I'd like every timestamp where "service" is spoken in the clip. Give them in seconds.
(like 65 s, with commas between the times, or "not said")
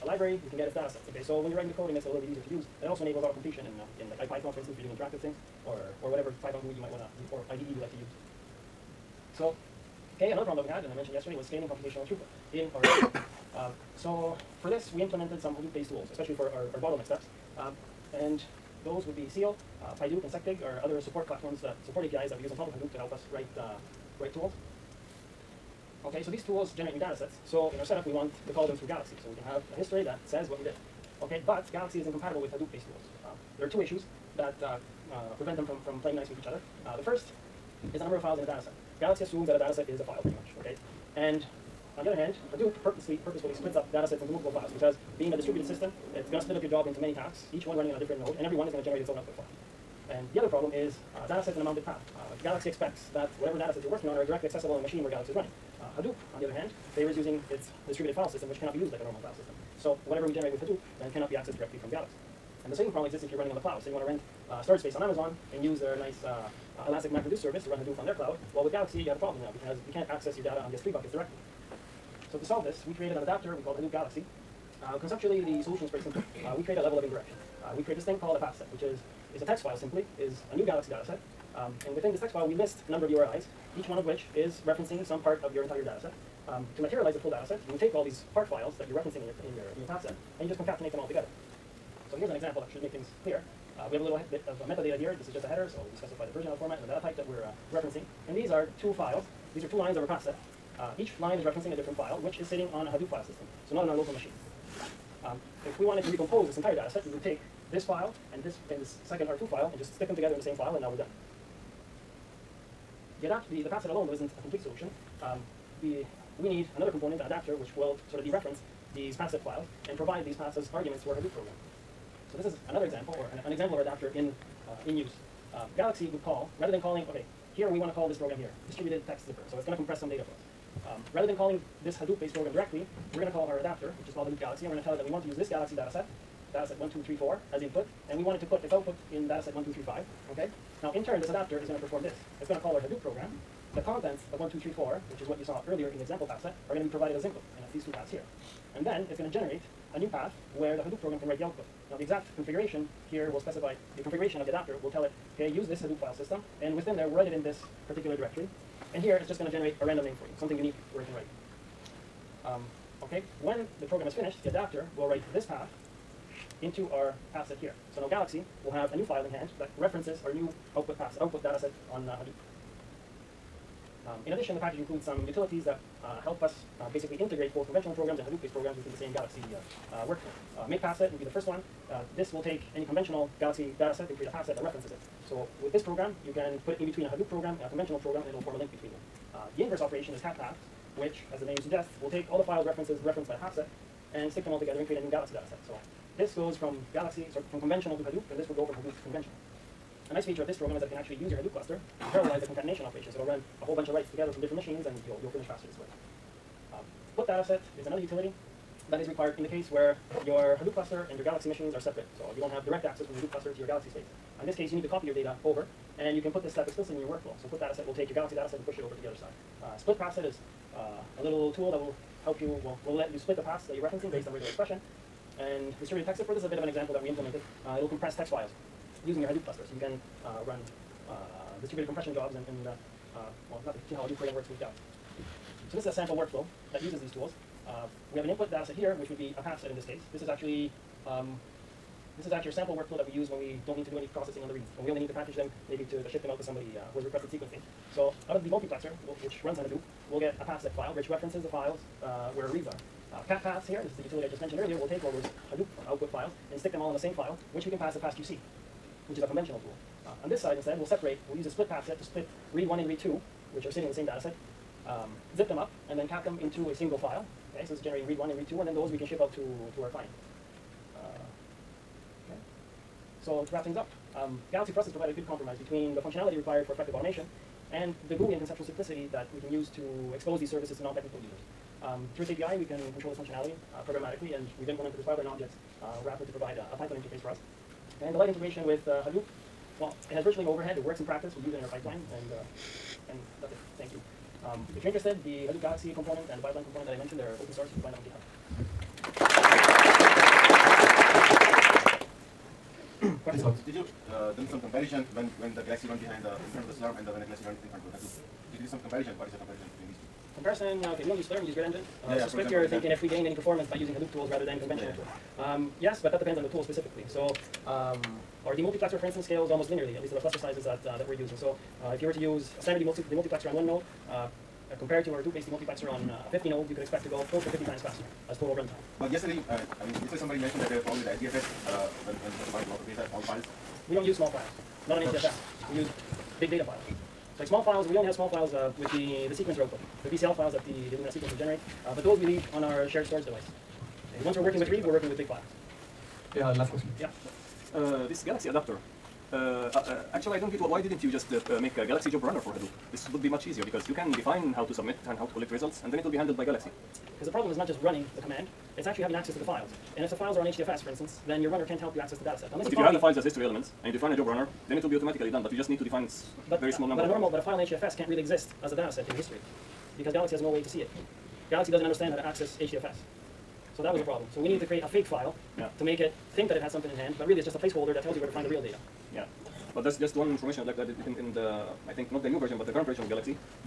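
67 s, 280 s.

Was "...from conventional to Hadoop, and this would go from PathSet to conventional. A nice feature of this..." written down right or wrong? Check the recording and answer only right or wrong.
wrong.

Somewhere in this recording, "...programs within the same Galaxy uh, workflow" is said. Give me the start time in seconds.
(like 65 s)
178 s.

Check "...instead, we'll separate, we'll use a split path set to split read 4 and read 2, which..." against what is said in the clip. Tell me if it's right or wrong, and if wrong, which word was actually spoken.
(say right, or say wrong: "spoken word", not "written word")
wrong: "1", not "4".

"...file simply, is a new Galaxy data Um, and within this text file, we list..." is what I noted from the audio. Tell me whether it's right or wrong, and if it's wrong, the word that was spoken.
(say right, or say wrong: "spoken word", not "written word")
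right.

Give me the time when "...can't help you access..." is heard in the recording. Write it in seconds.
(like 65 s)
361 s.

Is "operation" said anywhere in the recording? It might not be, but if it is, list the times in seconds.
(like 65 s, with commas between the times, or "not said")
189 s, 202 s.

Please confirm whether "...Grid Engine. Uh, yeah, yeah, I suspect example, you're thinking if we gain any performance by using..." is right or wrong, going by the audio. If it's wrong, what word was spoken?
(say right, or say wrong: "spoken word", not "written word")
right.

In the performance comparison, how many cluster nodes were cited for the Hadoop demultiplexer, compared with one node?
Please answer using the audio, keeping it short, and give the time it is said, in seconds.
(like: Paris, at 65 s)
50, at 326 s.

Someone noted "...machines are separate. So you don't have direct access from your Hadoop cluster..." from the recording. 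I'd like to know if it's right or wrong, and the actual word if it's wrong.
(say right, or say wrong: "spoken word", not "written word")
right.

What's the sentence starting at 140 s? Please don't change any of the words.
Now, in turn, this adapter is going to perform this it's going to call our Hadoop program.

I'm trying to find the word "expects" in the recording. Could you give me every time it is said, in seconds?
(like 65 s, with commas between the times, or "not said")
52 s, 326 s.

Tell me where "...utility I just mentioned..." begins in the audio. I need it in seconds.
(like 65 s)
254 s.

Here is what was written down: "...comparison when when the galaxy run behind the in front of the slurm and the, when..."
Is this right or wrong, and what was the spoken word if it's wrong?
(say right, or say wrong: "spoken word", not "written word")
right.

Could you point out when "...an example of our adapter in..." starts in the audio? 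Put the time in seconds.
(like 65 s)
123 s.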